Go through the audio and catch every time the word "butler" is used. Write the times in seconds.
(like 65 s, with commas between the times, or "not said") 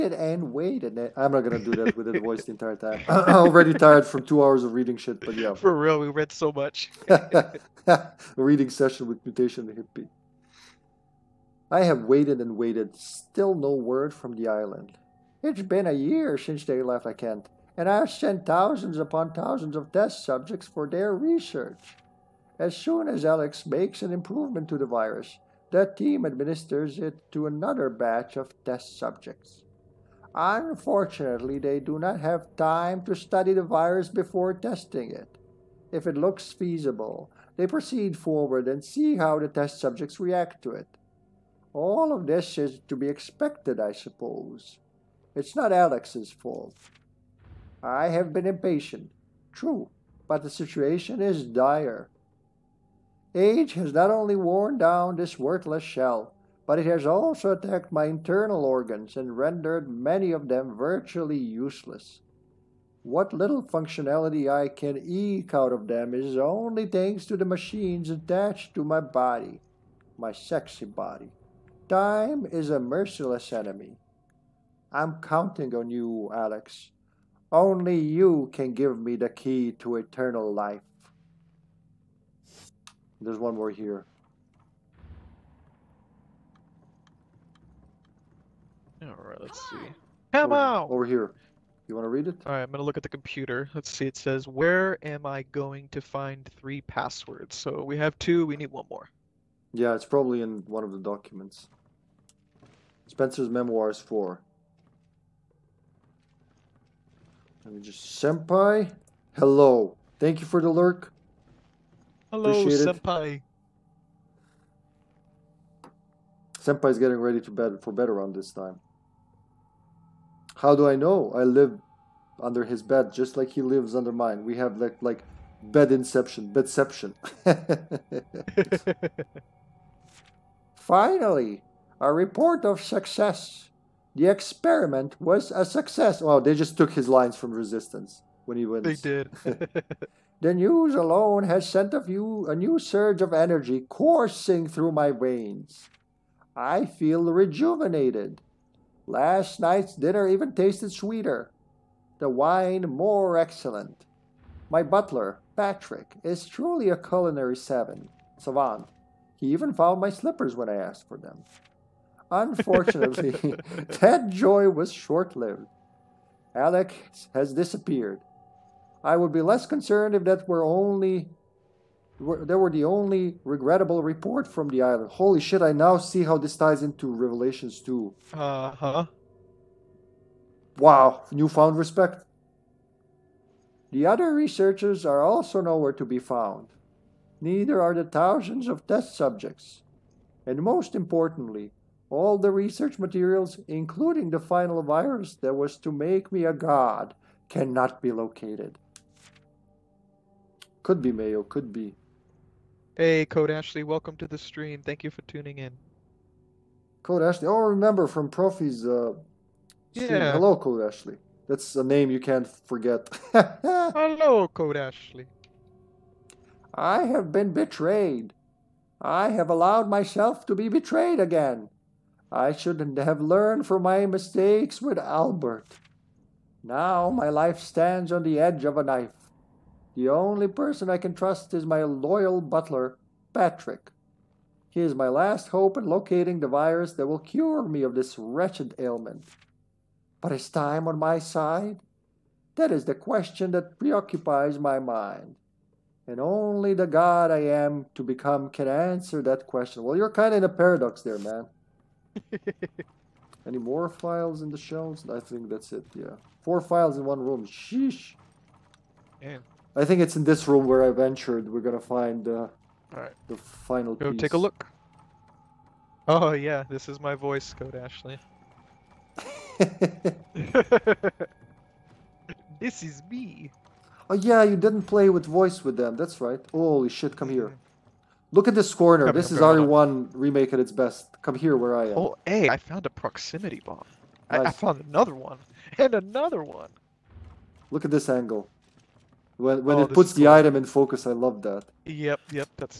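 154 s, 232 s.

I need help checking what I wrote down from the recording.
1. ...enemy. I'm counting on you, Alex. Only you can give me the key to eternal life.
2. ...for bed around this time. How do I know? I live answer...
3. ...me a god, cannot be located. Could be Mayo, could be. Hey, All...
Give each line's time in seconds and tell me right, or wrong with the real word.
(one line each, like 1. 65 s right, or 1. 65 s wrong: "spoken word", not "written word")
1. 73 s right
2. 117 s wrong: "under", not "answer"
3. 196 s wrong: "Code", not "All".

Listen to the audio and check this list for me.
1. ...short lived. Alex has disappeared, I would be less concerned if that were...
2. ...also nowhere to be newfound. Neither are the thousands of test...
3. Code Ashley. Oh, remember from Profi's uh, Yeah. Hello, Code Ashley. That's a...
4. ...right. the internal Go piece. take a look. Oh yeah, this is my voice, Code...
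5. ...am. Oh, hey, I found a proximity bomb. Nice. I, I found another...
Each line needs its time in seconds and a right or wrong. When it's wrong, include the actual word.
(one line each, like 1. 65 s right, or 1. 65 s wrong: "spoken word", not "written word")
1. 164 s right
2. 185 s wrong: "found", not "newfound"
3. 207 s right
4. 262 s wrong: "final", not "internal"
5. 281 s right.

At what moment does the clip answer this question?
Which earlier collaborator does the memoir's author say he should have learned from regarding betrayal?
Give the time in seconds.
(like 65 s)
224 s.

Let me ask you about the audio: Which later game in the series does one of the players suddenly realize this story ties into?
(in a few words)
Revelations 2.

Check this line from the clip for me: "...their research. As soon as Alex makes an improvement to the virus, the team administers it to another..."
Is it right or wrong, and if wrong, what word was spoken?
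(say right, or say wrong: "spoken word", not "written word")
right.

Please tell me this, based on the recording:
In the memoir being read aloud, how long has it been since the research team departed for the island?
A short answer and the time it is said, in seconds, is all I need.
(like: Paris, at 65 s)
a year, at 15 s.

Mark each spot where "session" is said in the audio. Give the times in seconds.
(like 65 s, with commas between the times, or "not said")
8 s.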